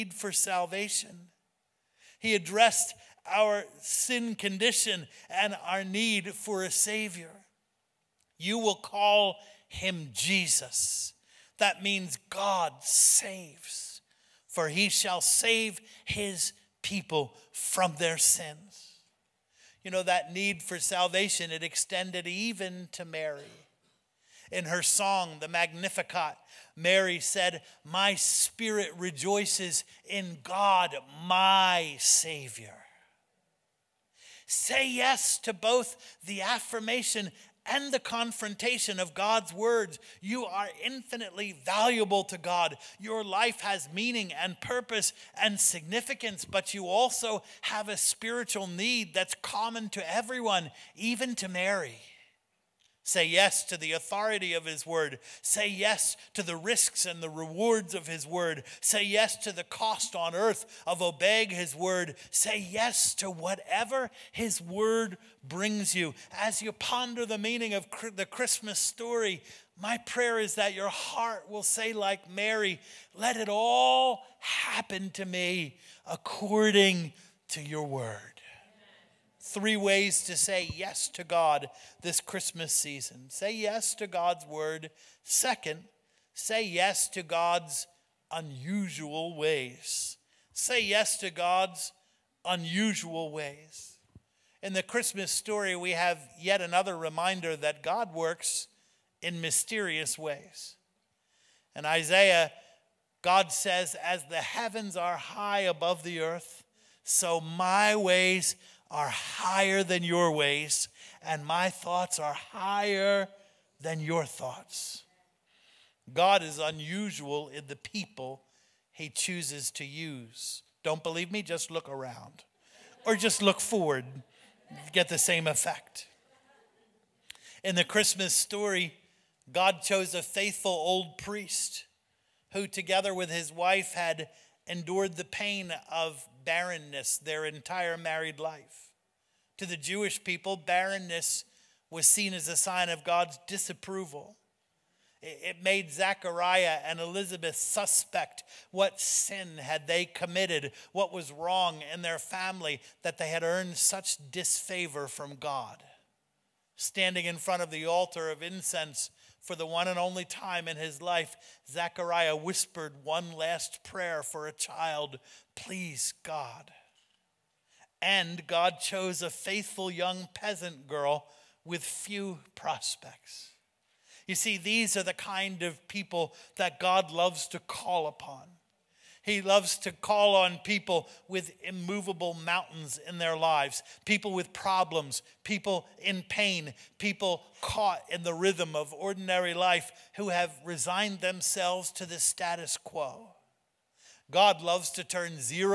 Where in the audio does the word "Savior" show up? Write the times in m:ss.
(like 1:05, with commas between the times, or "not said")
0:06, 0:31.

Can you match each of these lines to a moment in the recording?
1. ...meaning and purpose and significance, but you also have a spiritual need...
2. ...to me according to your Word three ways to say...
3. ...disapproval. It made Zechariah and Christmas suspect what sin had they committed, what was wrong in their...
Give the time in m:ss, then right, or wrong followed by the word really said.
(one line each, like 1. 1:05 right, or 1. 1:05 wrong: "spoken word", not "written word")
1. 0:43 right
2. 1:15 right
3. 2:23 wrong: "Elizabeth", not "Christmas".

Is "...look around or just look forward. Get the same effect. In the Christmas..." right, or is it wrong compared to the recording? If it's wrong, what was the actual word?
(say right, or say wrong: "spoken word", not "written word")
right.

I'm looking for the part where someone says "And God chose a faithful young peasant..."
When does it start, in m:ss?
2:48.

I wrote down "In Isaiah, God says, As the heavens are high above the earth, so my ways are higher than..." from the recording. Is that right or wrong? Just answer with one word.
right.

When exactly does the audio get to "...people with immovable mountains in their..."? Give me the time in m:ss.
3:00.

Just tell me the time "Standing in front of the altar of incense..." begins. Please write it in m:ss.
2:36.